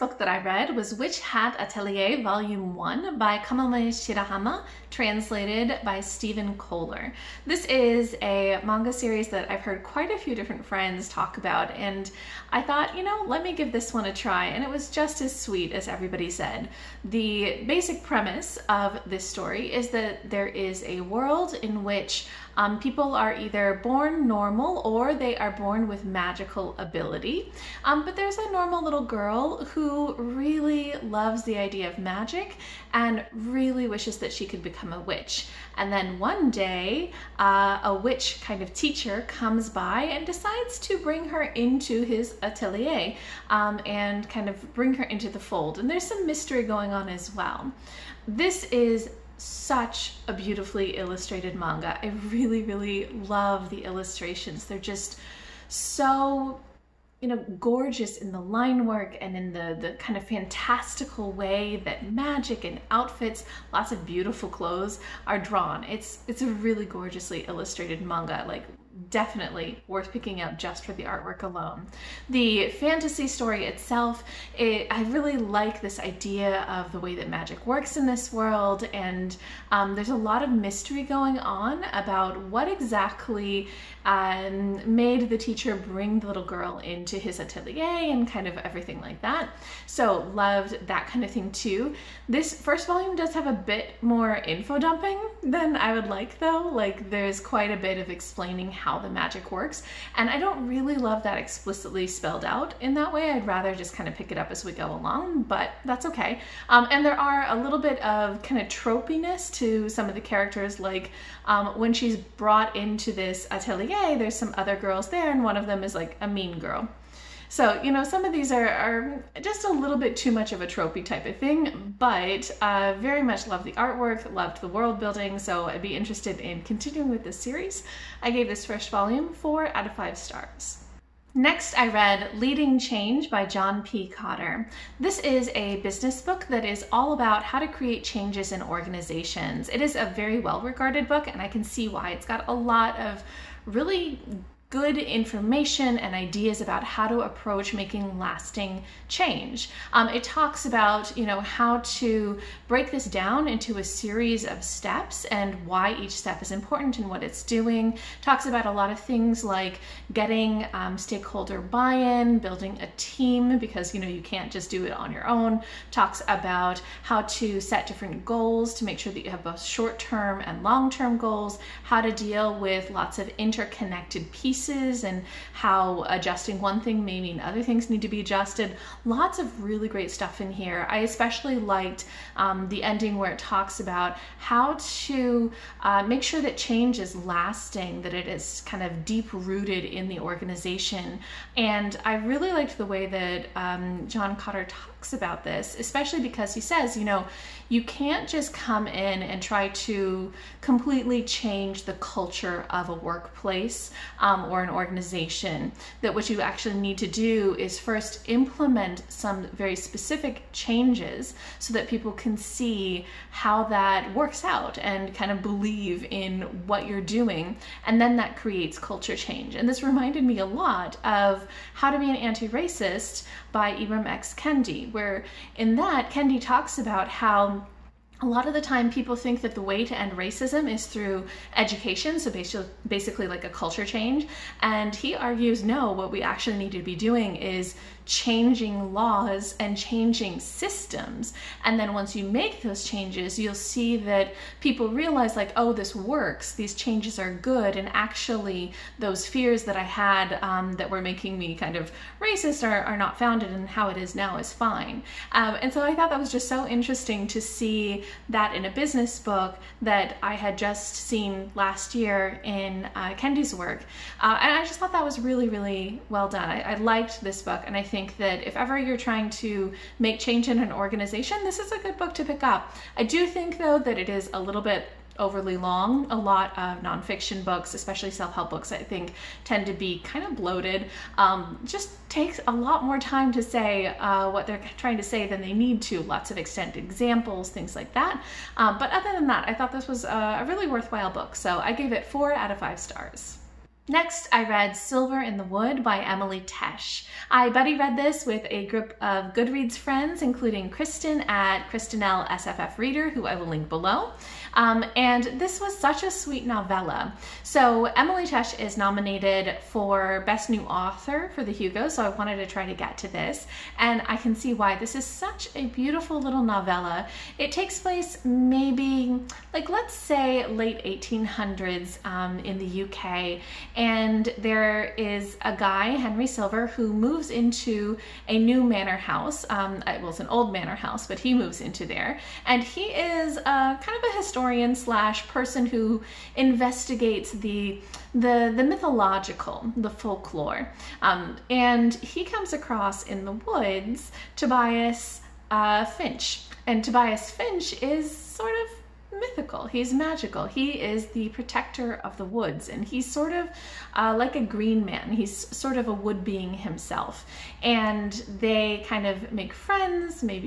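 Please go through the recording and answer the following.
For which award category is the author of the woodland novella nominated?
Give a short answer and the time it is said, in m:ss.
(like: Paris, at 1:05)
Best New Author, at 5:10.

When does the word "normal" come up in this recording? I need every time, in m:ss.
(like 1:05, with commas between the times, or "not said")
0:24, 0:28.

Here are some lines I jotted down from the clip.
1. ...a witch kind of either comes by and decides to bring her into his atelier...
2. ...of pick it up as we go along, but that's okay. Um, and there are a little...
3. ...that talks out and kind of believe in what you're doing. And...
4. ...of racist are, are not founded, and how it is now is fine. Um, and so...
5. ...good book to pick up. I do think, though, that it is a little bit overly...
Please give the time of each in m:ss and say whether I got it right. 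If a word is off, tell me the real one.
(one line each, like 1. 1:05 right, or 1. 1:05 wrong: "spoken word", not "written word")
1. 0:37 wrong: "teacher", not "either"
2. 1:44 right
3. 3:33 wrong: "works", not "talks"
4. 4:11 right
5. 4:31 right.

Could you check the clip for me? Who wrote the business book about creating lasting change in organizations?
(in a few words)
John P. Kotter.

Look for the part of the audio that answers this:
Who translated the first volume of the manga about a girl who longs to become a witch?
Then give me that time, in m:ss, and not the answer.
0:06.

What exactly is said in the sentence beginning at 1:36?
Like, there's quite a bit of explaining how the magic works.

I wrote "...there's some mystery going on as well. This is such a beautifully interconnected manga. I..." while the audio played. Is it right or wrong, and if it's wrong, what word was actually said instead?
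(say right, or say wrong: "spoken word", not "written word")
wrong: "illustrated", not "interconnected".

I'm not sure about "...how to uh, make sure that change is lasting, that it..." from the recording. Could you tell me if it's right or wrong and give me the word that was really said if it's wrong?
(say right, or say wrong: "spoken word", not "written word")
right.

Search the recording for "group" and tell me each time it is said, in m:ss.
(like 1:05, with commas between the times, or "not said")
4:58.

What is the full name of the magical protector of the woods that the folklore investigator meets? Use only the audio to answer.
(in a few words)
Tobias Finch.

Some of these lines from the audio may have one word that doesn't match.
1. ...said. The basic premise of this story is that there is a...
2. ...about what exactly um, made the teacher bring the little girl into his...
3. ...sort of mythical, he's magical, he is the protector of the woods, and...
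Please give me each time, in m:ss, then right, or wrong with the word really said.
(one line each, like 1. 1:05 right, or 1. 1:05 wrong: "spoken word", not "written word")
1. 0:16 right
2. 1:21 right
3. 5:48 right.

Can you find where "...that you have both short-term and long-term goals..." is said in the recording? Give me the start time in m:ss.
2:49.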